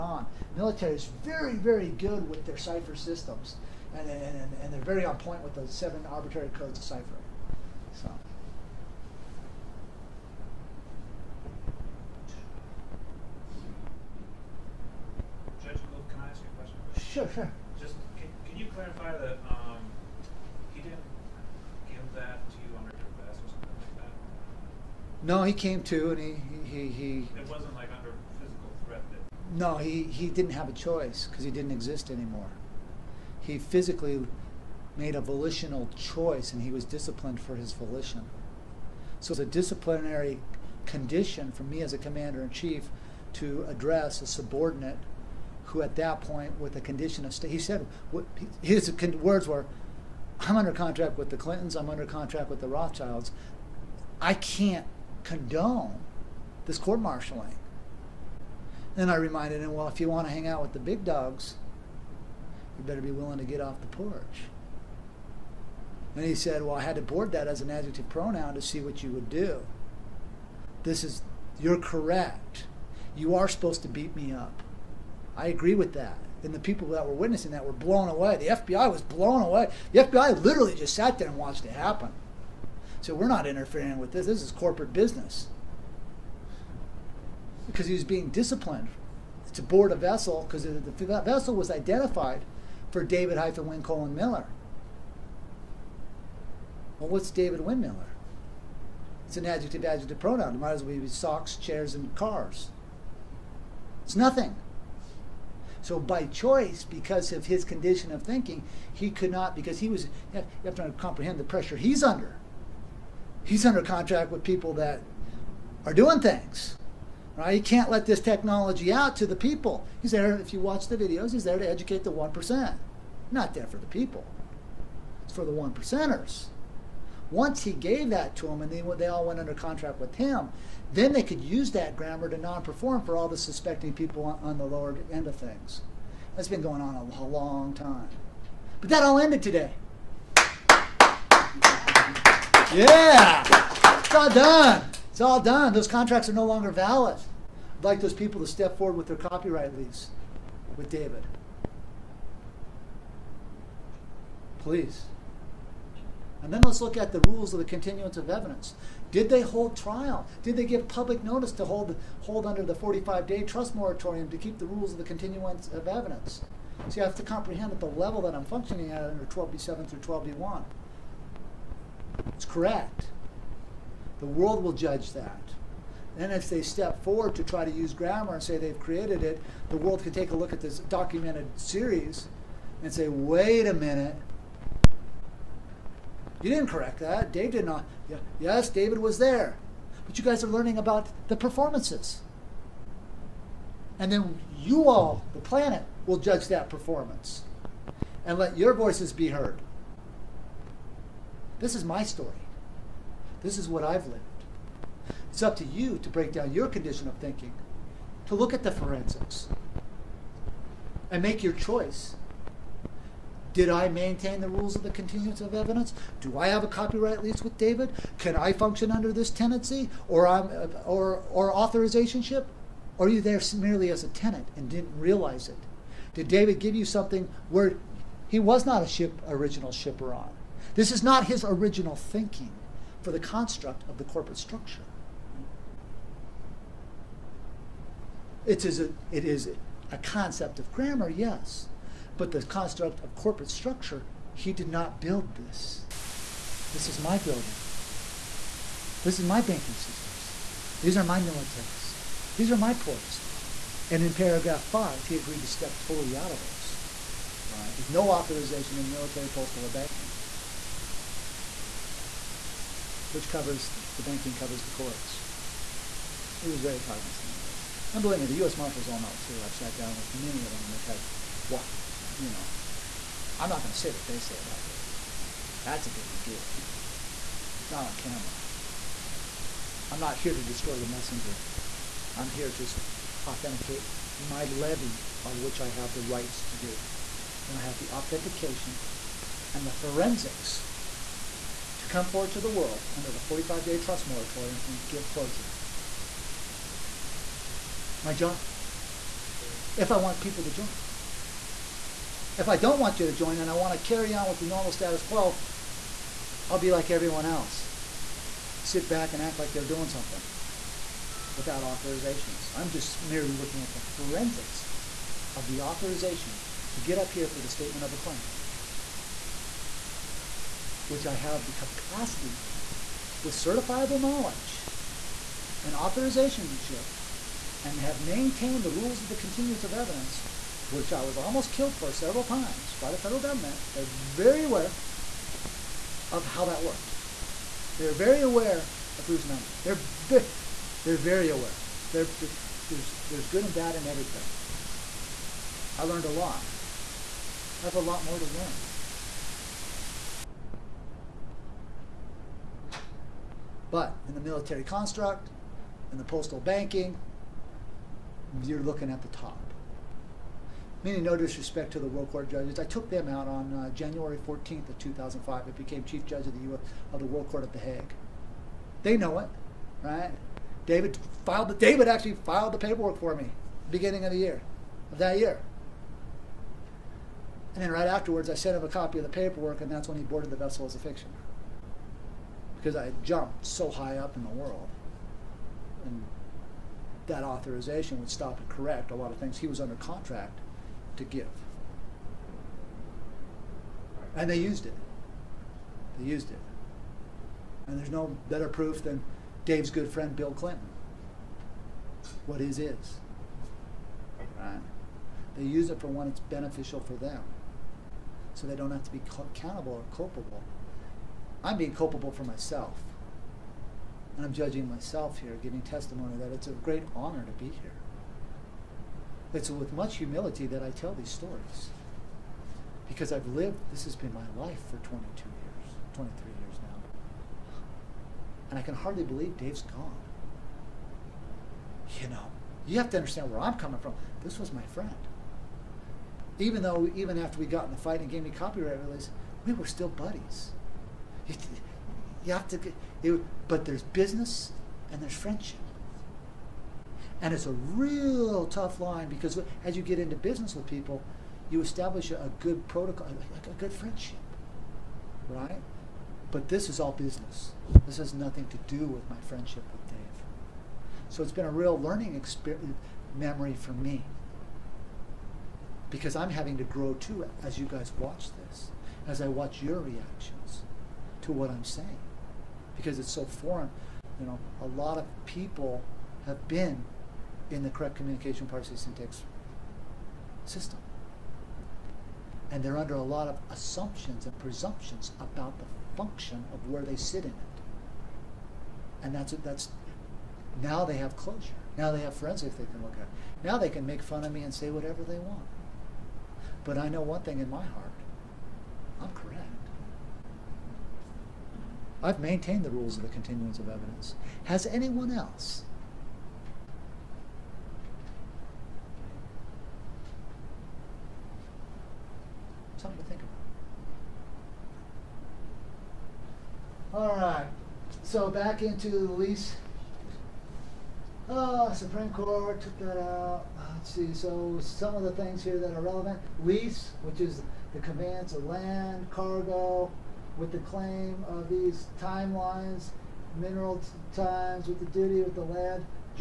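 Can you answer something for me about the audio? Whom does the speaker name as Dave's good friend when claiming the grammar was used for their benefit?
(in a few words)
Bill Clinton.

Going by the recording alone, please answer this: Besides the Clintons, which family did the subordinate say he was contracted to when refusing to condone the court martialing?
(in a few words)
Rothschilds.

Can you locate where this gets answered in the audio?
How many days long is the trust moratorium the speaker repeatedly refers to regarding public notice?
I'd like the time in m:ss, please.
2:42.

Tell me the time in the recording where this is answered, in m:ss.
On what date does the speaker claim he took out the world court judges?
6:03.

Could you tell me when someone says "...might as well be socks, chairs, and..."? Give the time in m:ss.
1:40.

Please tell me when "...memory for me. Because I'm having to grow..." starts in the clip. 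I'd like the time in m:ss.
7:43.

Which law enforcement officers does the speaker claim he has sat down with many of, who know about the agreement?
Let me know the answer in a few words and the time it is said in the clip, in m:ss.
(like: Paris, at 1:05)
U.S. Marshals, at 4:28.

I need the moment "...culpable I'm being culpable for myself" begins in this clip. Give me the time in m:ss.
6:49.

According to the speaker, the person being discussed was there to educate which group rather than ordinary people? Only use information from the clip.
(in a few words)
The 1%.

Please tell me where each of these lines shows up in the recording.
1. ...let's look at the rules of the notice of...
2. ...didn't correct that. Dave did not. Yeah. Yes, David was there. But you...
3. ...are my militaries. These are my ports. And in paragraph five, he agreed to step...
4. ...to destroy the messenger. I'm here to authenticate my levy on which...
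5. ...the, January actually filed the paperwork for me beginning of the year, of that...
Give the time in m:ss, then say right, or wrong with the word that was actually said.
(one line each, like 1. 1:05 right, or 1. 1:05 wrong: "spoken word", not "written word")
1. 2:36 wrong: "continuance", not "notice"
2. 3:06 right
3. 4:10 right
4. 4:40 right
5. 6:11 wrong: "David", not "January".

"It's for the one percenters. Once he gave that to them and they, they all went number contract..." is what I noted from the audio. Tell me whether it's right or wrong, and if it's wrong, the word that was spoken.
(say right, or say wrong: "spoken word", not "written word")
wrong: "under", not "number".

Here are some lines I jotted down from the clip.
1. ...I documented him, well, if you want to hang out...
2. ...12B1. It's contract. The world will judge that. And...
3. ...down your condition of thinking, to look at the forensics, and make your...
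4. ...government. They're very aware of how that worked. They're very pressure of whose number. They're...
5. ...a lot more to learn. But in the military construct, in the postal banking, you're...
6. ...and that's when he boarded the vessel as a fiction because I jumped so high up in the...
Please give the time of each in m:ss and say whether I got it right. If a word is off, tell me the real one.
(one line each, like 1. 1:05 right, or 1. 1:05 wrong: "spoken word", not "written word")
1. 0:59 wrong: "reminded", not "documented"
2. 2:49 wrong: "correct", not "contract"
3. 3:26 right
4. 5:33 wrong: "aware", not "pressure"
5. 5:47 right
6. 6:19 right.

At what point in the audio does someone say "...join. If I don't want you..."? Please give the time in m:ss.
5:00.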